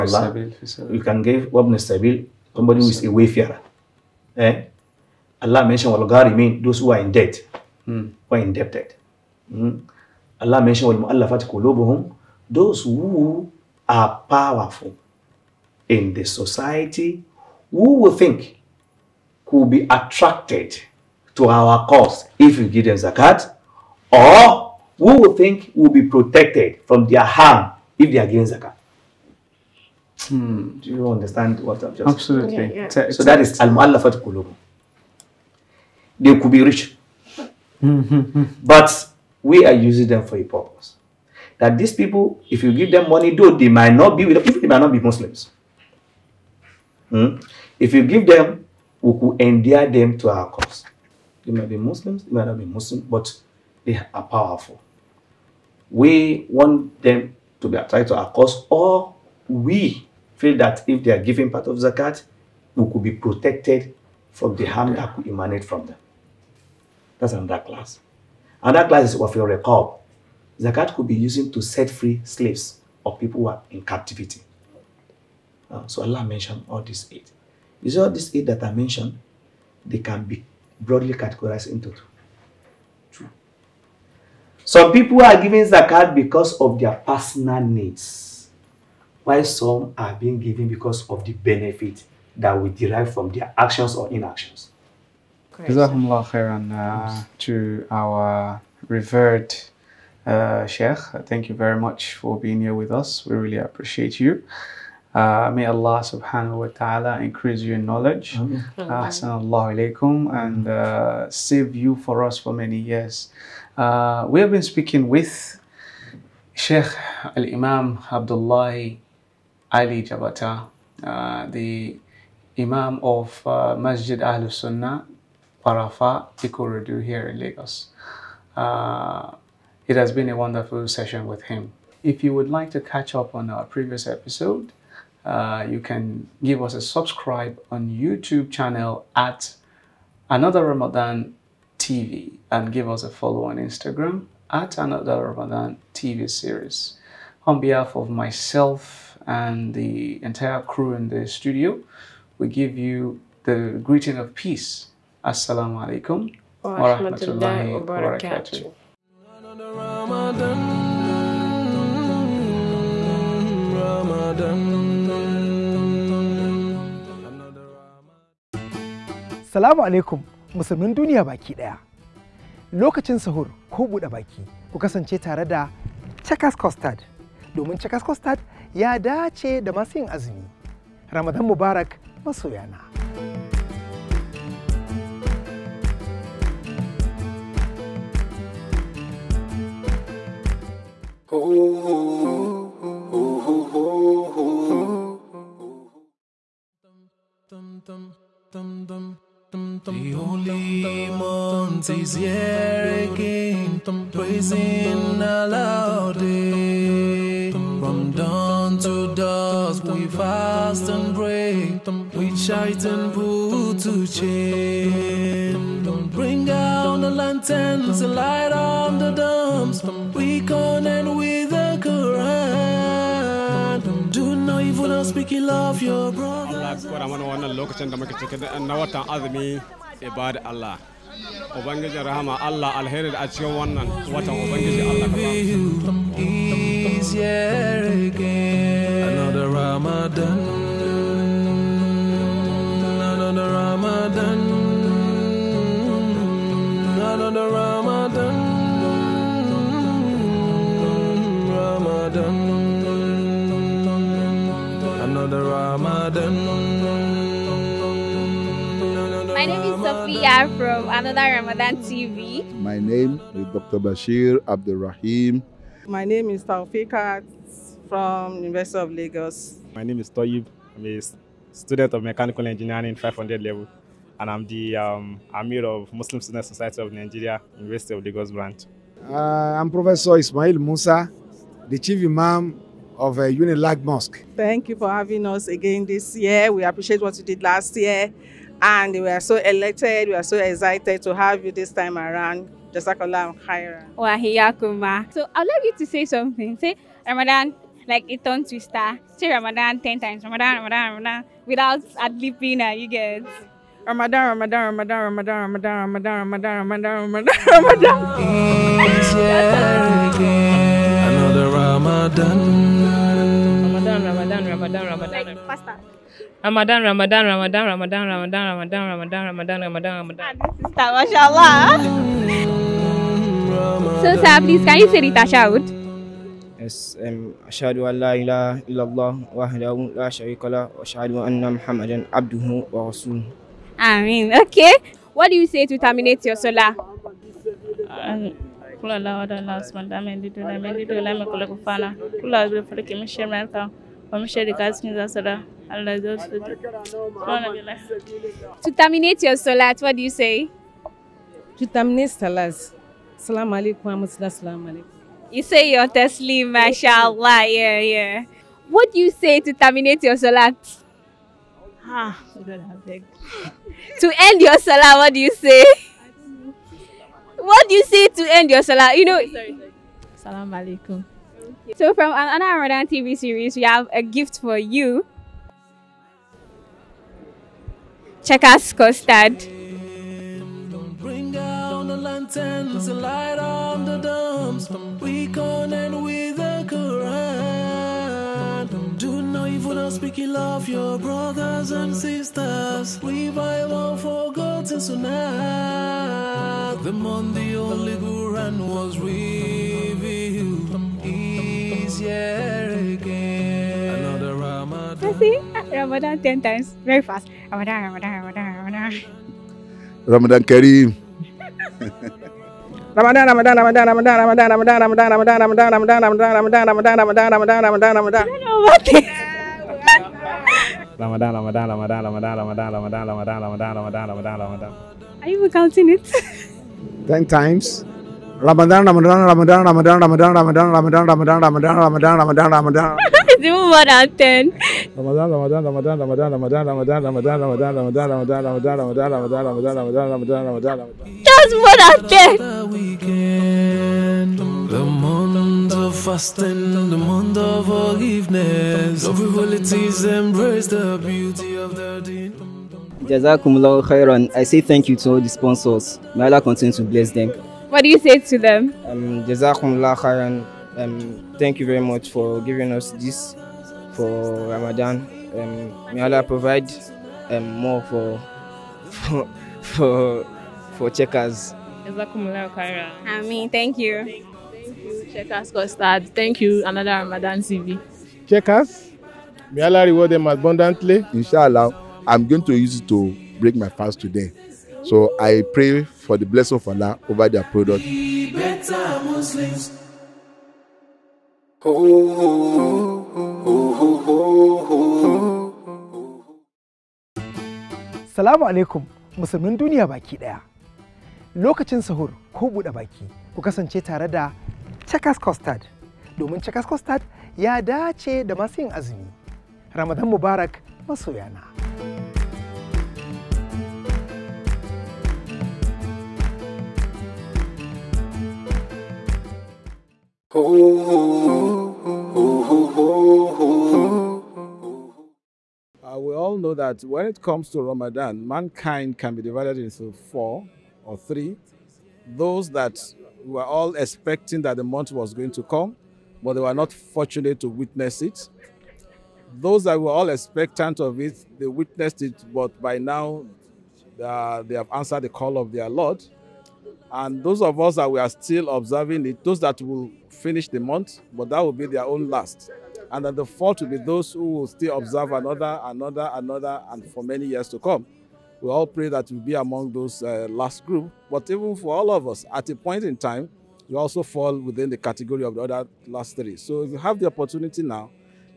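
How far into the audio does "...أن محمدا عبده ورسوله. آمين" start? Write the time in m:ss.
5:31.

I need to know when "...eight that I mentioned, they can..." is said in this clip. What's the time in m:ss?
1:18.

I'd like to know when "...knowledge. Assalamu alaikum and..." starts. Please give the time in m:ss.
1:47.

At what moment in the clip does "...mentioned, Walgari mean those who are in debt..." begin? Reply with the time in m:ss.
0:05.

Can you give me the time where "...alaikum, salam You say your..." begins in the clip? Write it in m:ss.
5:53.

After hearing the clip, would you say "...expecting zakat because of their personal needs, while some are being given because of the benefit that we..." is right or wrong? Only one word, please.
wrong.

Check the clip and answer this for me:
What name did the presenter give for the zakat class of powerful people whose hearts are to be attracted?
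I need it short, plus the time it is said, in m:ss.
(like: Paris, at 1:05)
al-mu'allafat Kulubu, at 0:33.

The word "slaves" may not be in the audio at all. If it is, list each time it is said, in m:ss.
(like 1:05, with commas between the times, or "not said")
1:12.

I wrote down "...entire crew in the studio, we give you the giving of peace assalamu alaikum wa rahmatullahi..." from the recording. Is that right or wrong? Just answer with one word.
wrong.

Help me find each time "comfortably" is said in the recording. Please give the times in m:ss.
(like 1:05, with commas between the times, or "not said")
not said.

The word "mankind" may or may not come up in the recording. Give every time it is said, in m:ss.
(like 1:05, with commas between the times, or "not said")
8:48.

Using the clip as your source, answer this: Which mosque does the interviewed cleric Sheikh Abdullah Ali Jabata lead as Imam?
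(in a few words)
Masjid Ahlus Sunnah Parafa Ikorodu.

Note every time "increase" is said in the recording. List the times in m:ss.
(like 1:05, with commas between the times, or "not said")
1:47.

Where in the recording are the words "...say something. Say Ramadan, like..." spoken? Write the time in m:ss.
4:55.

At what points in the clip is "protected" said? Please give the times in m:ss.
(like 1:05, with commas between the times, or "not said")
0:26, 1:03.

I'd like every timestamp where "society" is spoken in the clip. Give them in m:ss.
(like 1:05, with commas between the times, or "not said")
0:16, 4:36.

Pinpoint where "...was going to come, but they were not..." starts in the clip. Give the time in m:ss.
8:54.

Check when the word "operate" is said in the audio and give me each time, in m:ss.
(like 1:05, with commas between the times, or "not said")
not said.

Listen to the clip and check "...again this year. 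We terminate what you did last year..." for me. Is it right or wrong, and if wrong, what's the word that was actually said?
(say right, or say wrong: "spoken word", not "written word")
wrong: "appreciate", not "terminate".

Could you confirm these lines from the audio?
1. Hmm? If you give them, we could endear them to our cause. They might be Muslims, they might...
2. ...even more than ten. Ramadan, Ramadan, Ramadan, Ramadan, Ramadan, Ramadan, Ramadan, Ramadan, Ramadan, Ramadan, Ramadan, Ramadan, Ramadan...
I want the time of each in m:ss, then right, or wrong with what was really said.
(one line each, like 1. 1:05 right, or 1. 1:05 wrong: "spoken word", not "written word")
1. 0:47 right
2. 7:13 right.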